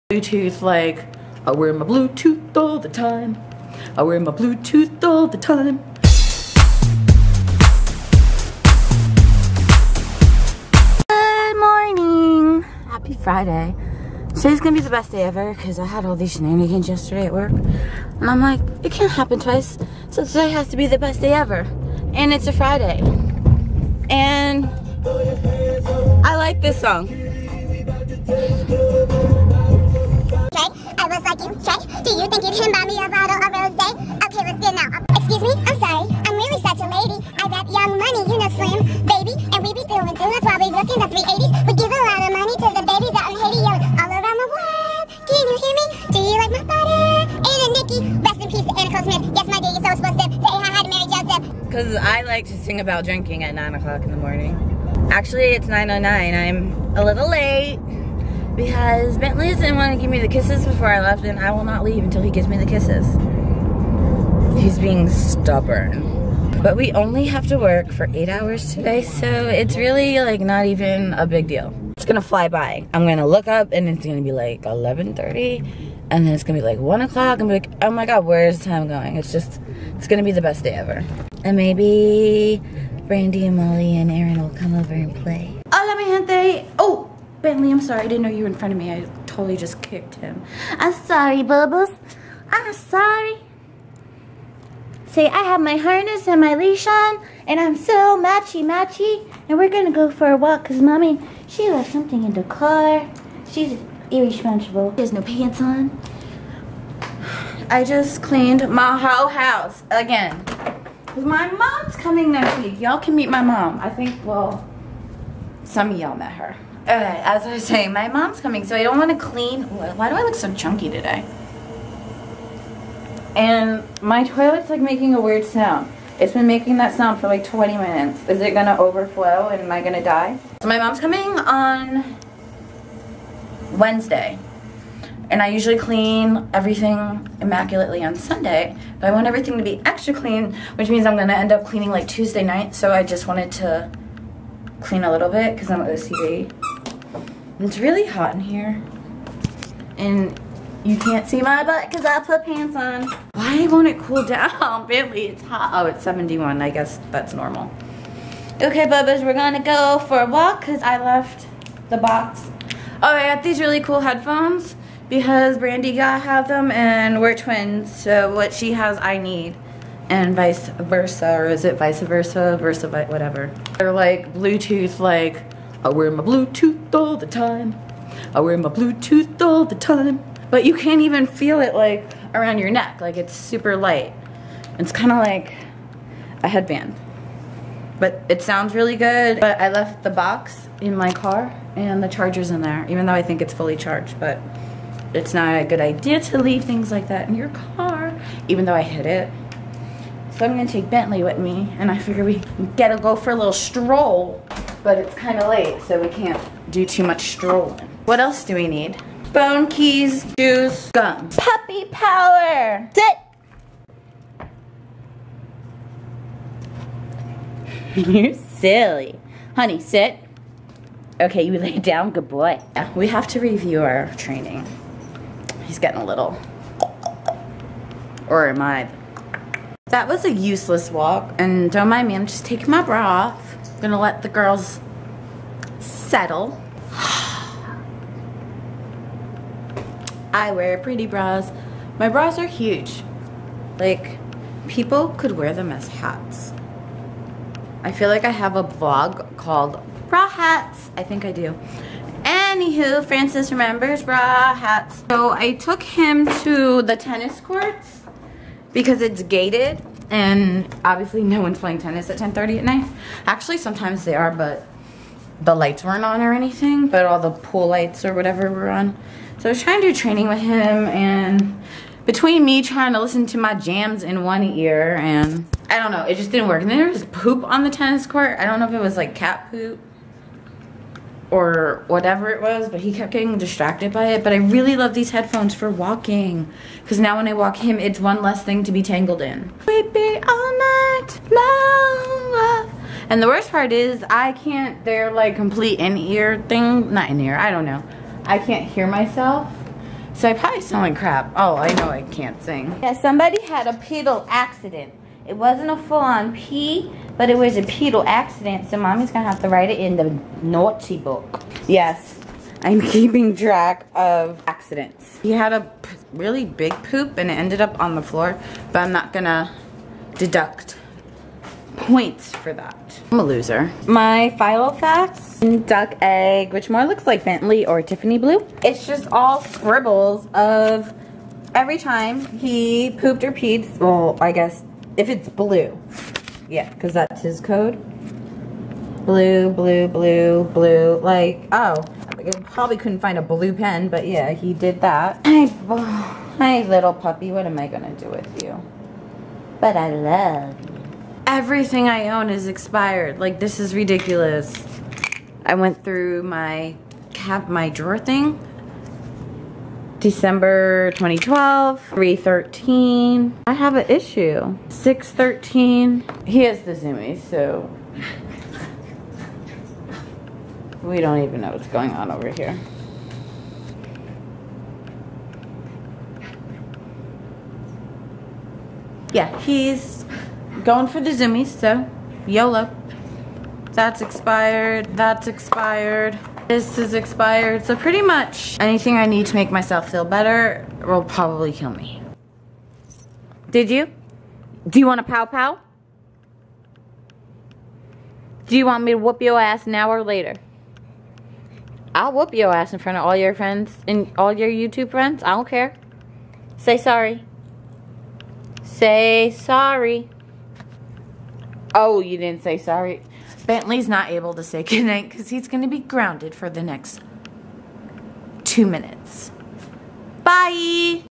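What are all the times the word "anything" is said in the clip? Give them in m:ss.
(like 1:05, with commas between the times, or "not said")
4:26, 6:28.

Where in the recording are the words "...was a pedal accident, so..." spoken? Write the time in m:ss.
5:07.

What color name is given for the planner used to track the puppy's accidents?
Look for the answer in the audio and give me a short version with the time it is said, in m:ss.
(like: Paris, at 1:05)
duck egg, at 5:25.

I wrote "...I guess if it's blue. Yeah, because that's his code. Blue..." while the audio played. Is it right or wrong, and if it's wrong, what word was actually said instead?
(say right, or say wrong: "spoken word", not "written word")
right.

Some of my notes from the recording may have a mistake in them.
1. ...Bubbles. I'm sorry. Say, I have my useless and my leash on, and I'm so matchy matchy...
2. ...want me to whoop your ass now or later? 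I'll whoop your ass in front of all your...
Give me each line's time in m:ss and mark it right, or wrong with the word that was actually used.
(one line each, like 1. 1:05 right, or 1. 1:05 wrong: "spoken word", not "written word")
1. 1:31 wrong: "harness", not "useless"
2. 6:38 right.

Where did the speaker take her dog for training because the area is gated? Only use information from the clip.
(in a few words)
tennis courts.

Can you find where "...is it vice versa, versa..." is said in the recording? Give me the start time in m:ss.
2:51.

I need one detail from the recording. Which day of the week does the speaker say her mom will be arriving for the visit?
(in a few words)
Wednesday.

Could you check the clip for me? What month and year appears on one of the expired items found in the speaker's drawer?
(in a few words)
December 2012.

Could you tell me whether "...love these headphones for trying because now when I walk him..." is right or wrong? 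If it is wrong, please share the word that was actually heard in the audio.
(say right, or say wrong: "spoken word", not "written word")
wrong: "walking", not "trying".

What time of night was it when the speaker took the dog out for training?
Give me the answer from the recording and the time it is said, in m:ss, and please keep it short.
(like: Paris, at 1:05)
10:30, at 4:22.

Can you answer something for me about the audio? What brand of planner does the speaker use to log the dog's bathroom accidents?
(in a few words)
Filofax.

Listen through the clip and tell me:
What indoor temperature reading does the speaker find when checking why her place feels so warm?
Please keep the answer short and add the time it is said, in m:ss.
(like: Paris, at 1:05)
71, at 2:36.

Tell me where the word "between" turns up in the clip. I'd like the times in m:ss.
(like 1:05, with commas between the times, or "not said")
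4:32.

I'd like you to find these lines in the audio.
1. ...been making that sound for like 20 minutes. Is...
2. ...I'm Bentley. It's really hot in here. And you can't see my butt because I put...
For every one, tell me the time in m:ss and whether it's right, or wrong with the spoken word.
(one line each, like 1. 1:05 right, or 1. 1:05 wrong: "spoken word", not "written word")
1. 2:06 right
2. 2:25 wrong: "OCD", not "Bentley".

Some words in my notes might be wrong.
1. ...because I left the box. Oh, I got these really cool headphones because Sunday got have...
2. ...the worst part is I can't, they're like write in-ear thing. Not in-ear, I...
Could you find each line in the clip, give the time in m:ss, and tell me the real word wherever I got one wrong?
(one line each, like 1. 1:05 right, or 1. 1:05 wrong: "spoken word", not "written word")
1. 2:40 wrong: "Brandi", not "Sunday"
2. 4:53 wrong: "complete", not "write".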